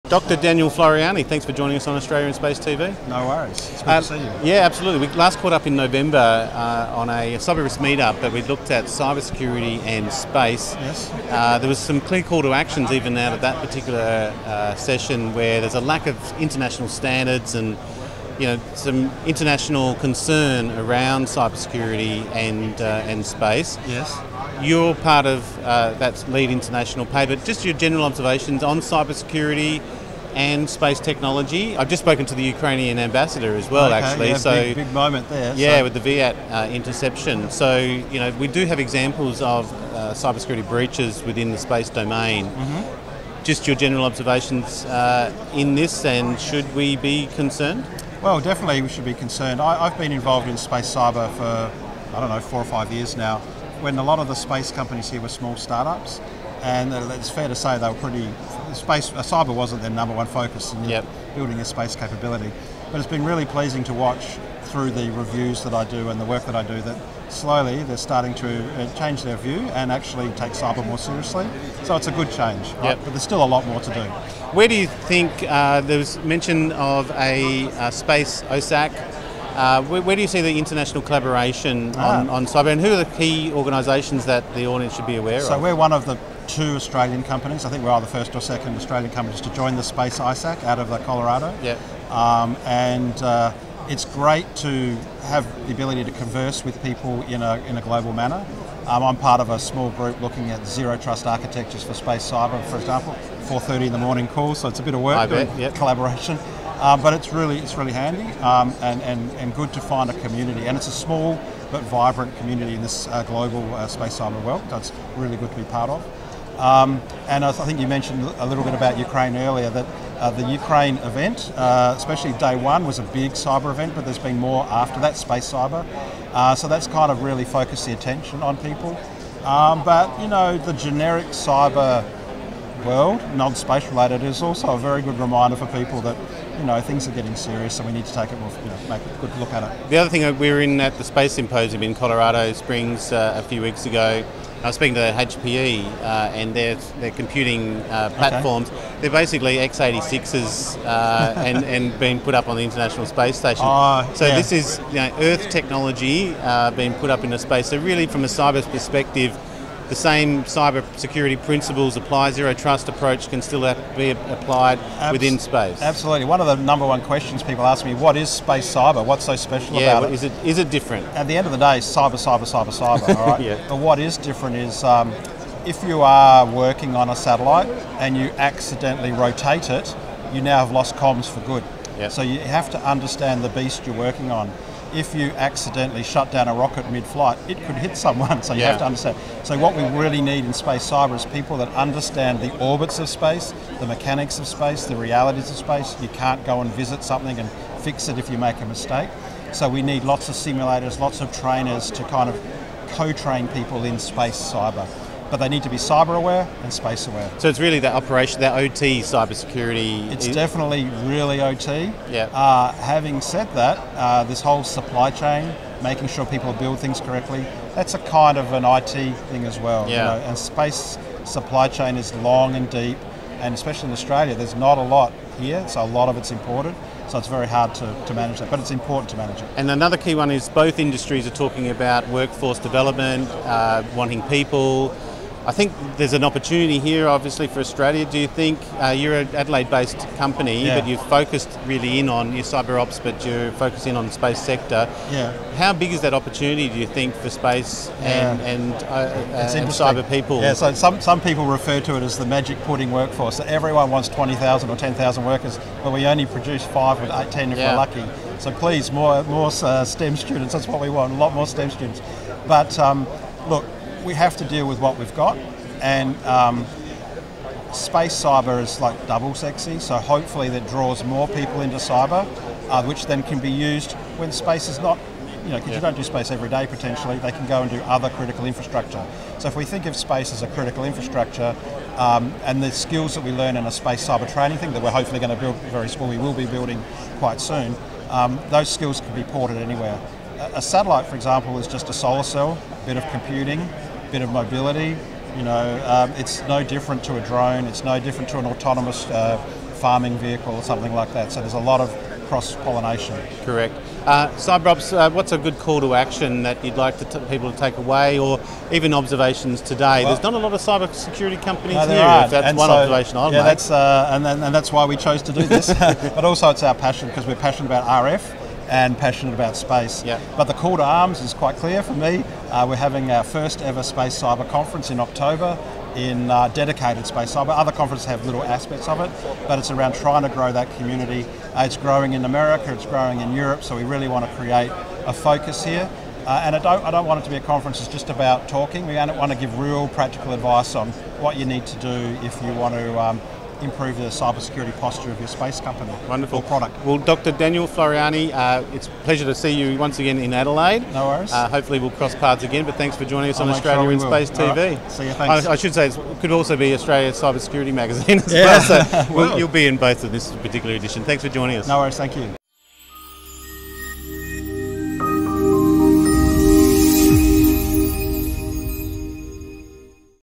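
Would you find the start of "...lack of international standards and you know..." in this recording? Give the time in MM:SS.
00:15.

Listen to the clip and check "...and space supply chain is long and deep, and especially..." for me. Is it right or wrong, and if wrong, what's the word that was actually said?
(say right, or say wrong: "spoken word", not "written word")
right.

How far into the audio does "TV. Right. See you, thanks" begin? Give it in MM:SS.
05:54.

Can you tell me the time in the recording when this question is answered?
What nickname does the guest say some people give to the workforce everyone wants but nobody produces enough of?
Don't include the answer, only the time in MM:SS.
04:12.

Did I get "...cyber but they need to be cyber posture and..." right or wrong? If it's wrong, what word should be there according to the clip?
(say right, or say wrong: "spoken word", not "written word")
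wrong: "aware", not "posture".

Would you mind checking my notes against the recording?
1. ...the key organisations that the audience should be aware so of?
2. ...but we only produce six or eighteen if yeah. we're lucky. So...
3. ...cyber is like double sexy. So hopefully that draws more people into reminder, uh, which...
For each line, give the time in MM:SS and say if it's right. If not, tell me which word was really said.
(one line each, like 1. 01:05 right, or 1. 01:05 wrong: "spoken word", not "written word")
1. 01:23 right
2. 04:15 wrong: "five", not "six"
3. 04:28 wrong: "cyber", not "reminder".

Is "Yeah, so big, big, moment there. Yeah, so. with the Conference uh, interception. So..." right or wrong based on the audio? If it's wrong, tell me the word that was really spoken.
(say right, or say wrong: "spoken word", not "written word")
wrong: "Viasat", not "Conference".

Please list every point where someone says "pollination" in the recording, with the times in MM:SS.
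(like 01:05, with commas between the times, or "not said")
05:02.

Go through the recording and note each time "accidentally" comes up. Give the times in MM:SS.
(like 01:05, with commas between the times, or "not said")
02:58, 03:05.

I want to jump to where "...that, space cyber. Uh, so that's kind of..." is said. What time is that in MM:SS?
02:05.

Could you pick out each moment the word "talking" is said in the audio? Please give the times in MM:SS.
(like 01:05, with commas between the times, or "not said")
03:51, 05:38.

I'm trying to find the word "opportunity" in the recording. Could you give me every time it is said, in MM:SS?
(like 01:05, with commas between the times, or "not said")
03:56, 04:06.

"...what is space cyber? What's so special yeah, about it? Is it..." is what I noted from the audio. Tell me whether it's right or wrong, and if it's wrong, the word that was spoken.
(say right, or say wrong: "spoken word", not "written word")
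right.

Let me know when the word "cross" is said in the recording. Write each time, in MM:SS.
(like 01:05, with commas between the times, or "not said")
05:02, 05:51.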